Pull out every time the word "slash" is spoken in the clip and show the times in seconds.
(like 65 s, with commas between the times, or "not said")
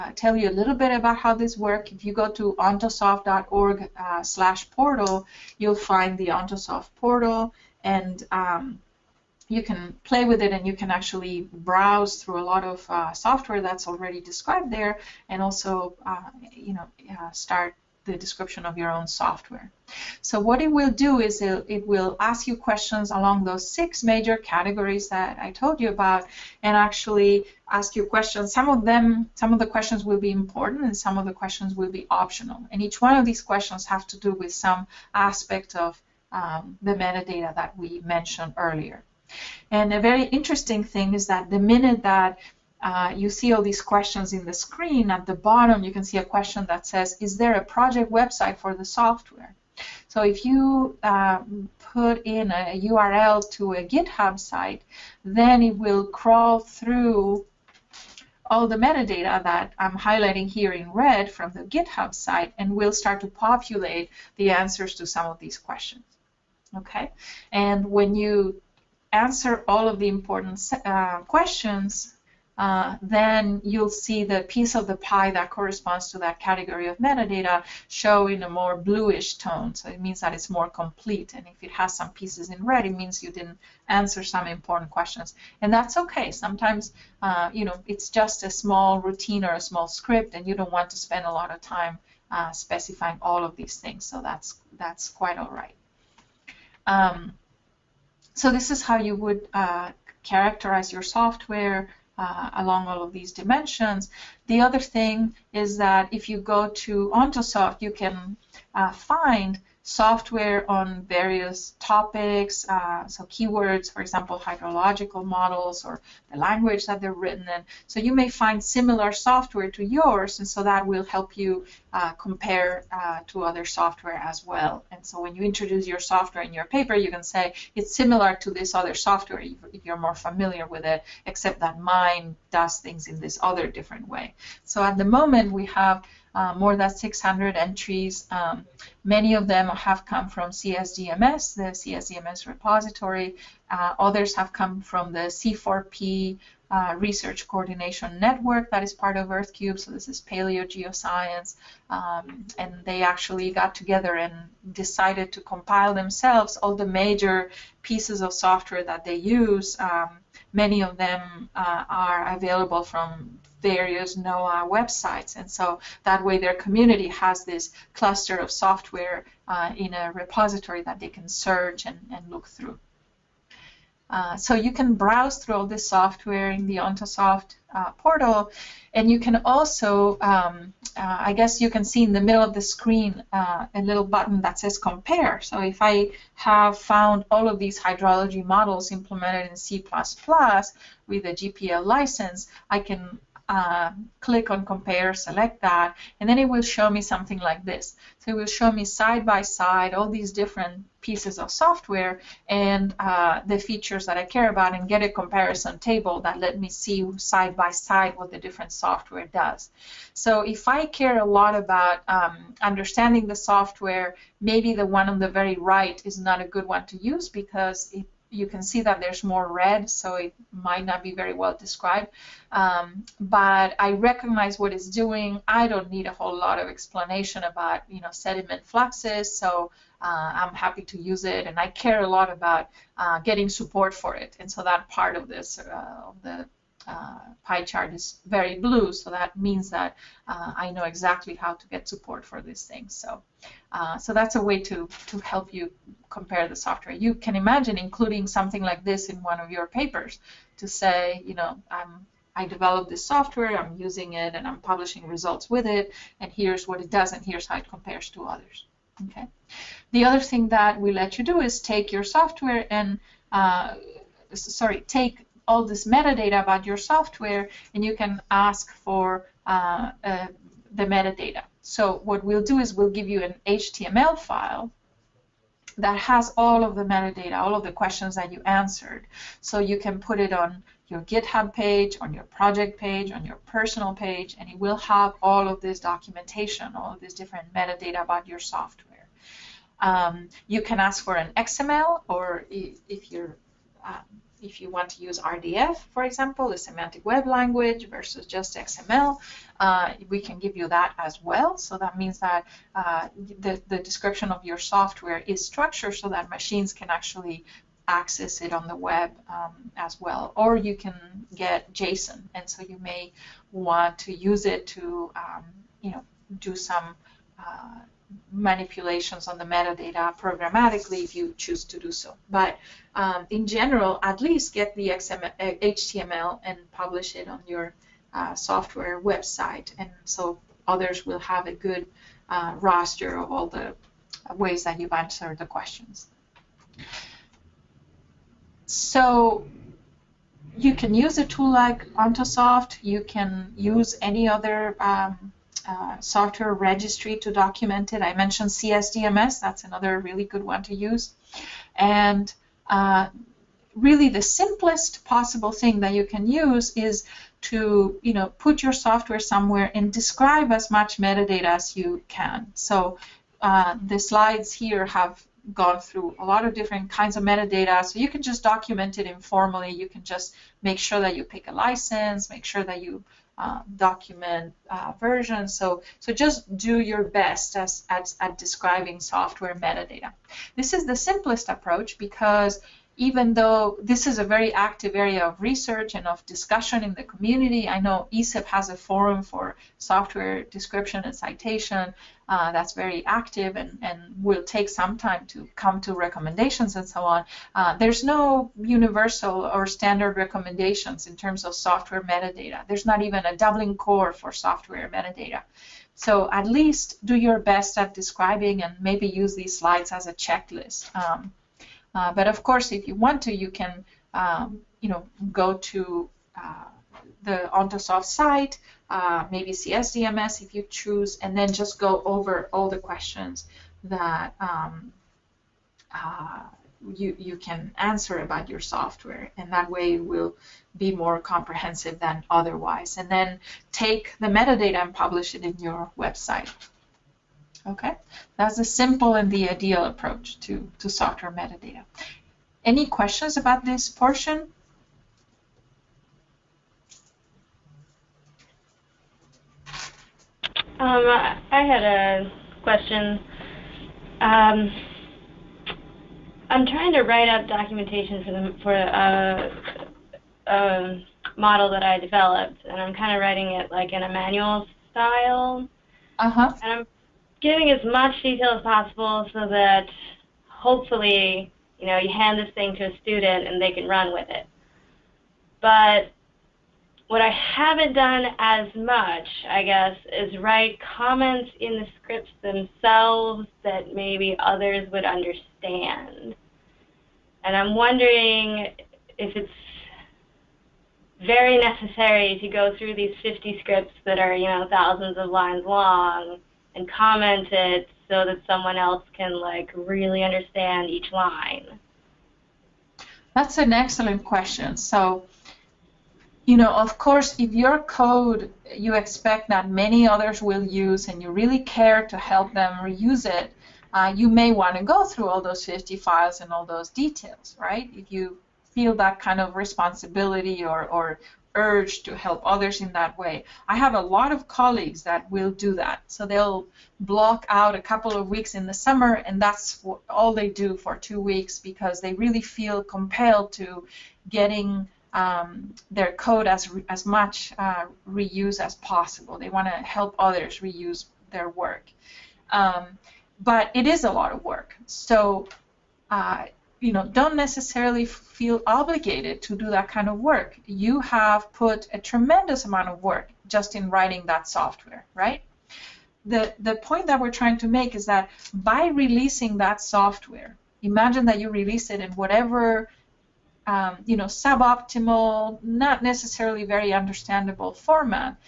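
4 s.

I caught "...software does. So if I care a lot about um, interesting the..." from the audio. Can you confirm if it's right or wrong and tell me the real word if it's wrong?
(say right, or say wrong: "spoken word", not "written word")
wrong: "understanding", not "interesting".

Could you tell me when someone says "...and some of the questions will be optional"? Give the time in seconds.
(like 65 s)
30 s.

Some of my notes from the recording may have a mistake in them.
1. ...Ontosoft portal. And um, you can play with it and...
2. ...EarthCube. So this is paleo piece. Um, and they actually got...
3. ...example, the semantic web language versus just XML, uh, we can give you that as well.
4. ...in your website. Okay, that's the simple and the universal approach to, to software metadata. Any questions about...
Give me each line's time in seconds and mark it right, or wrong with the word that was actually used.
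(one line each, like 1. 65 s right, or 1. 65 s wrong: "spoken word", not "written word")
1. 6 s right
2. 149 s wrong: "geoscience", not "piece"
3. 296 s right
4. 435 s wrong: "ideal", not "universal".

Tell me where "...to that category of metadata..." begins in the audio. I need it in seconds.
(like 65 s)
76 s.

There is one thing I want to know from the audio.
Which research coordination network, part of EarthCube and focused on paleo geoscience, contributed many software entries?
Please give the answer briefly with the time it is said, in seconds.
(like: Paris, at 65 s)
C4P, at 145 s.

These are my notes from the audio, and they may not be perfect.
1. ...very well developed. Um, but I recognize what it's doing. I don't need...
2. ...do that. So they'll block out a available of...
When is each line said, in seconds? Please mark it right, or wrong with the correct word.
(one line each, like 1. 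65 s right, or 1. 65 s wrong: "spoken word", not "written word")
1. 221 s wrong: "described", not "developed"
2. 525 s wrong: "couple", not "available".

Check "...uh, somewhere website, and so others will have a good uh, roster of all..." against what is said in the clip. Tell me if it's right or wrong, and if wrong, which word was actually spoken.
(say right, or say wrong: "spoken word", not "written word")
wrong: "software", not "somewhere".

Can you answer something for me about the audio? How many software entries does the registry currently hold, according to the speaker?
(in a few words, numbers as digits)
More than 600.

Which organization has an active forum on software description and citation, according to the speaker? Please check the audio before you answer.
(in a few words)
ESIP.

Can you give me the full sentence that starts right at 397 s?
Uh, there's no universal or standard recommendations in terms of software metadata.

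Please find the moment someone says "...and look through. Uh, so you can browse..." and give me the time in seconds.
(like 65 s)
172 s.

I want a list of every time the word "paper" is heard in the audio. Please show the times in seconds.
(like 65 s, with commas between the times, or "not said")
126 s, 249 s.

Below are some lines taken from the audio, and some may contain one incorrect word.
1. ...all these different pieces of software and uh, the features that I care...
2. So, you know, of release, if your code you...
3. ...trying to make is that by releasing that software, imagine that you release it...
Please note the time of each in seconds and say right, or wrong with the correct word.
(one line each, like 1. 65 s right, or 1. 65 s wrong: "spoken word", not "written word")
1. 199 s right
2. 504 s wrong: "course", not "release"
3. 557 s right.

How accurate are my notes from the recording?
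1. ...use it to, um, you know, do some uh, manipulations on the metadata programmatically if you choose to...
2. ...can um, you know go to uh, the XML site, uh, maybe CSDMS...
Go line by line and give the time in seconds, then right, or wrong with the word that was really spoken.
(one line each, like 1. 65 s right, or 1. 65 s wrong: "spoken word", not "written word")
1. 314 s right
2. 413 s wrong: "Ontosoft", not "XML".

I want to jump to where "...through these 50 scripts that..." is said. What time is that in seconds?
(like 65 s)
492 s.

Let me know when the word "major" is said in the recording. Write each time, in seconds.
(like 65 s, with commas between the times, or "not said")
24 s, 156 s.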